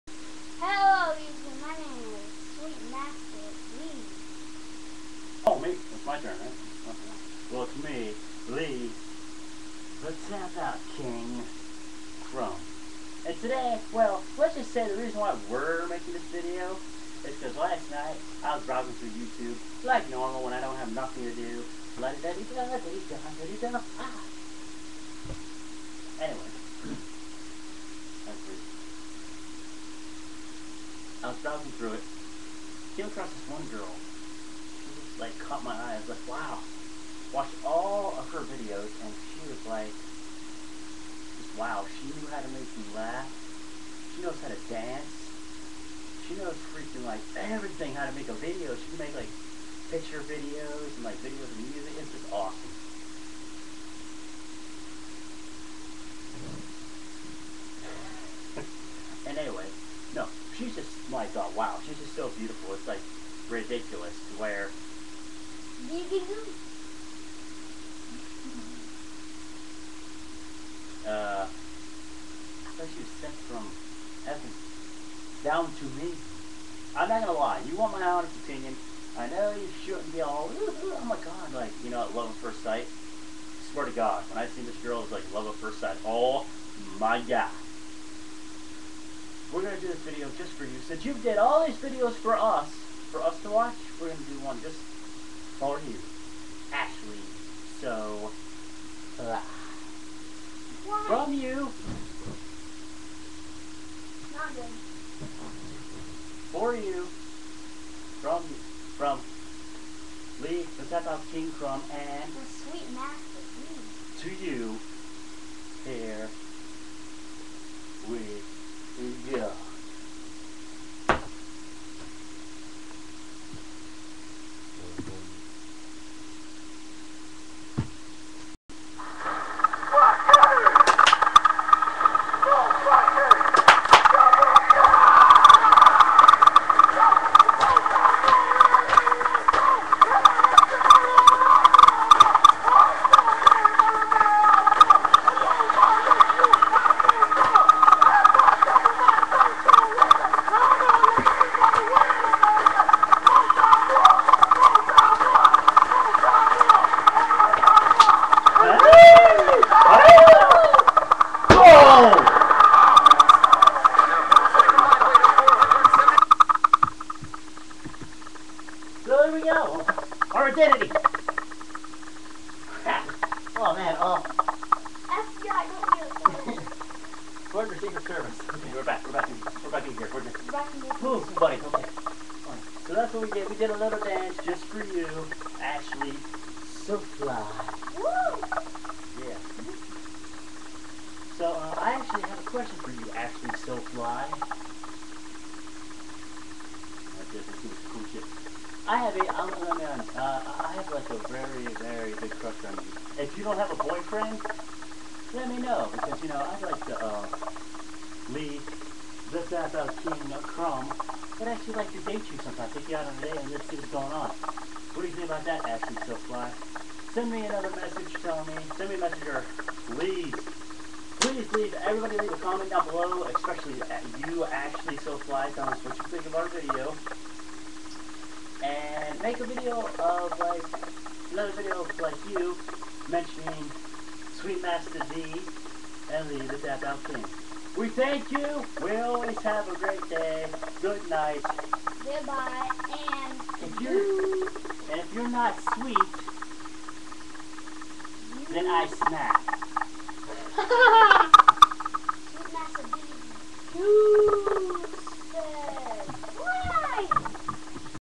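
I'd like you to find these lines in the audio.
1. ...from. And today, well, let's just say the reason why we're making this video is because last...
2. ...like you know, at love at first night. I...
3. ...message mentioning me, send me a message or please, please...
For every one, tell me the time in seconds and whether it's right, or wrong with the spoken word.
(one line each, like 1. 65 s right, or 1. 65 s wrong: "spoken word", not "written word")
1. 12 s right
2. 81 s wrong: "sight", not "night"
3. 217 s wrong: "telling", not "mentioning".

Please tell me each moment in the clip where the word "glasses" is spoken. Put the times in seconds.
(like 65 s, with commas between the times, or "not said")
not said.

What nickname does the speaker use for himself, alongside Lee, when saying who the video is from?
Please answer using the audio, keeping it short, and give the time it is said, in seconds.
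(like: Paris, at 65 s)
the King Crum, at 110 s.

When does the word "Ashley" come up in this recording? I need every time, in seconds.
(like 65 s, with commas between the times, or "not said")
96 s, 185 s, 215 s, 224 s.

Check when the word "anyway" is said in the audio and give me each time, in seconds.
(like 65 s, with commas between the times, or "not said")
22 s, 59 s.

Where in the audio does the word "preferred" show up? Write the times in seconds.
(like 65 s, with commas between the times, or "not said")
not said.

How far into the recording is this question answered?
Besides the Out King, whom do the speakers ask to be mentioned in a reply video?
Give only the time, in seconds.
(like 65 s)
234 s.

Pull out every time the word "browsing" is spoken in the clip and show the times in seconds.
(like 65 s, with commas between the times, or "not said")
18 s, 31 s.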